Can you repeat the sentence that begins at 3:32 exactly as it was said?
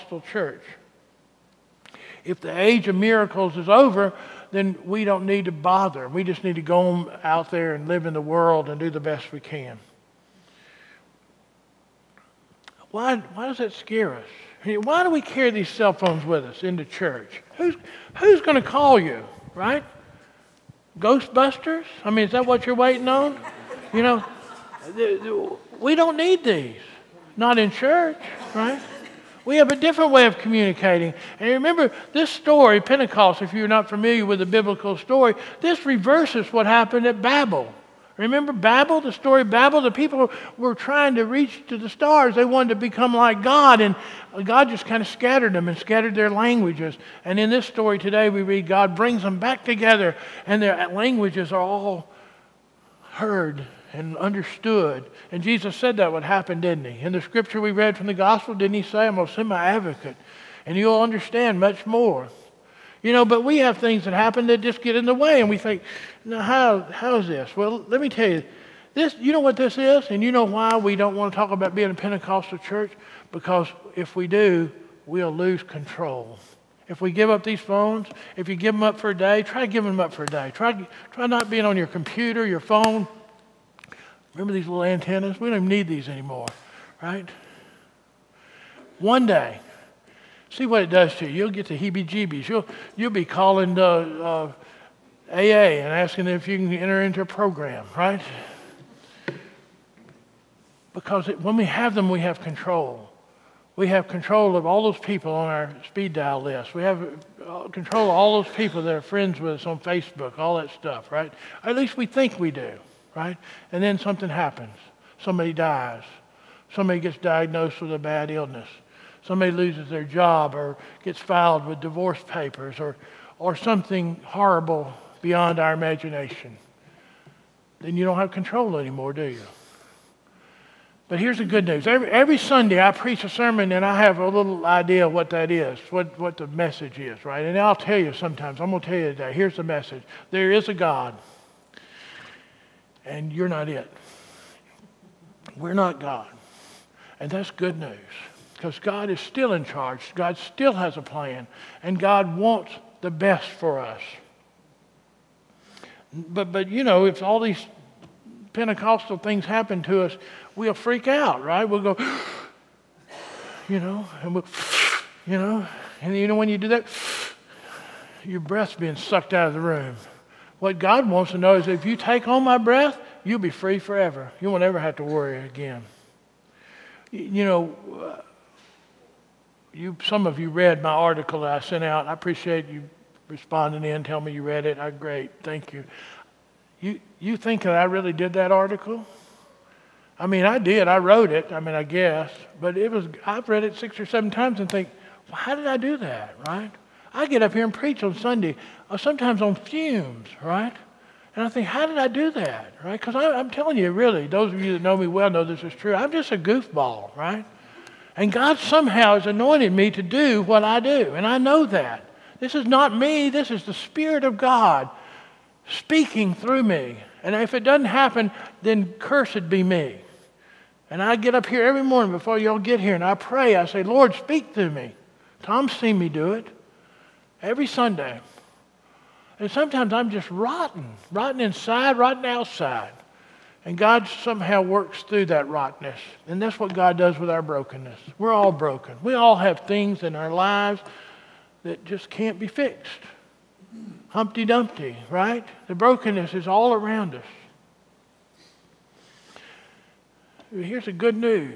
This is not me, this is the Spirit of God speaking through me.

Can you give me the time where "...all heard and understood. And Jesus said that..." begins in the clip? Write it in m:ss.
0:51.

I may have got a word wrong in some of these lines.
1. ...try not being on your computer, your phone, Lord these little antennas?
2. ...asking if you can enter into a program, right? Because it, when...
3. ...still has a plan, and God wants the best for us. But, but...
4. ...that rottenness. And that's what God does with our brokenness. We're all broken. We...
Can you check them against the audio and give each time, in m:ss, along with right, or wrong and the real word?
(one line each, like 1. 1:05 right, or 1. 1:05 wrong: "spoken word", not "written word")
1. 1:21 wrong: "Remember", not "Lord"
2. 1:35 right
3. 2:30 right
4. 3:55 right.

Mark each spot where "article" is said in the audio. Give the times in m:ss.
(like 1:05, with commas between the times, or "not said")
3:00, 3:08.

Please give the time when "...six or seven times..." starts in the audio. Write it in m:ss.
3:13.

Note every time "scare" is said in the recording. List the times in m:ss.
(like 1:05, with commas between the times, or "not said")
0:13.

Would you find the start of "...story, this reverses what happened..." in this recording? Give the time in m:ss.
0:34.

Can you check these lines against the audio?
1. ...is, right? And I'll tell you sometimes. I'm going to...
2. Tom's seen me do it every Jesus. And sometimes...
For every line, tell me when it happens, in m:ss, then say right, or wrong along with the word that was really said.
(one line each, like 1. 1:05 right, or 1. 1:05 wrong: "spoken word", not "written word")
1. 2:16 right
2. 3:45 wrong: "Sunday", not "Jesus".